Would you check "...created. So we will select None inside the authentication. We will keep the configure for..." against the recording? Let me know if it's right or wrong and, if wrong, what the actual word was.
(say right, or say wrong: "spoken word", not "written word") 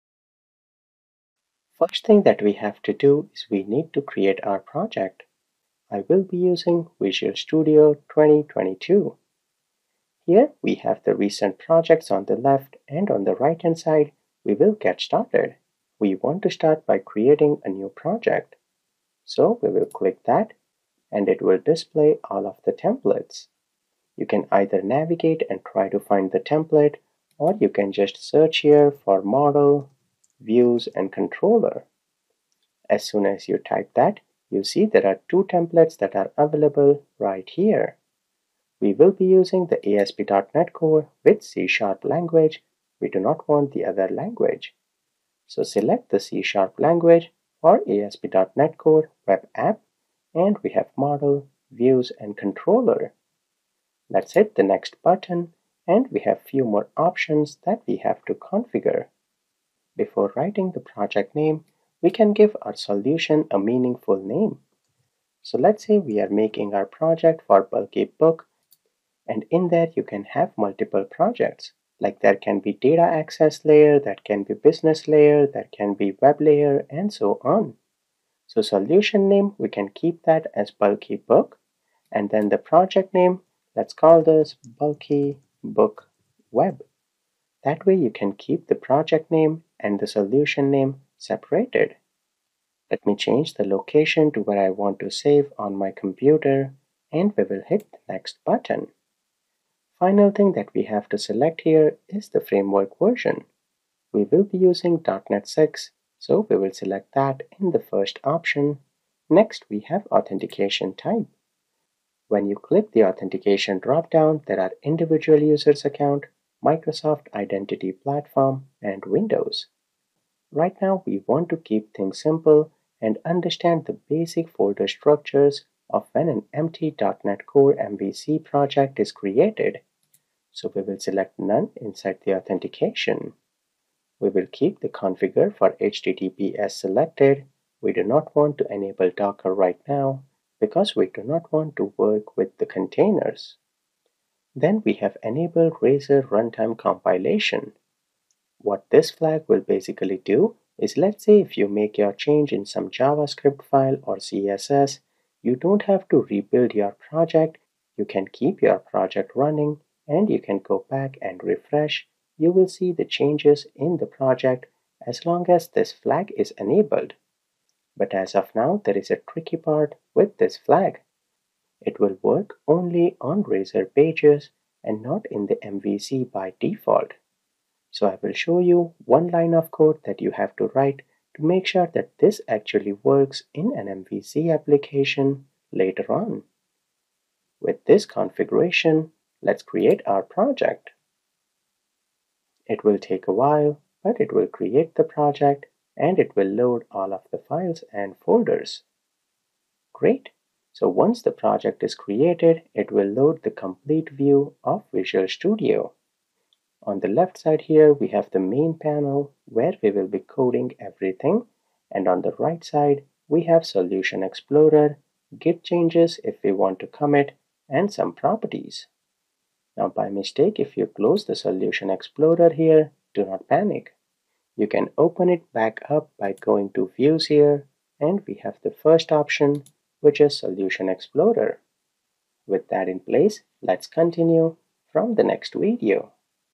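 right.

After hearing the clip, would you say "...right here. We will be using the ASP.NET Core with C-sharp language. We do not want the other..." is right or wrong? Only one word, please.
right.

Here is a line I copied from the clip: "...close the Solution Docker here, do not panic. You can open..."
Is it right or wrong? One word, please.
wrong.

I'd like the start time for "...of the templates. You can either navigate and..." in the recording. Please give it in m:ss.
0:22.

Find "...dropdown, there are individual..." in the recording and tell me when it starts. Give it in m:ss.
1:53.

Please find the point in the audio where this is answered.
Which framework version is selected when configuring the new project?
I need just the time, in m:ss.
1:45.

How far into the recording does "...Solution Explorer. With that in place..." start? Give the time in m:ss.
3:50.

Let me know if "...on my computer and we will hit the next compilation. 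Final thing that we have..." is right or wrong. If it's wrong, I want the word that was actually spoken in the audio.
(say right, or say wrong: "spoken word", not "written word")
wrong: "button", not "compilation".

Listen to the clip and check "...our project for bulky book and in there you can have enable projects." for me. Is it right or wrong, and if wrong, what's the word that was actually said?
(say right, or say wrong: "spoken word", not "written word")
wrong: "multiple", not "enable".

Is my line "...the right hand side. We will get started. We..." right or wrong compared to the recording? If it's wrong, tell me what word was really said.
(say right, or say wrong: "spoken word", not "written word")
right.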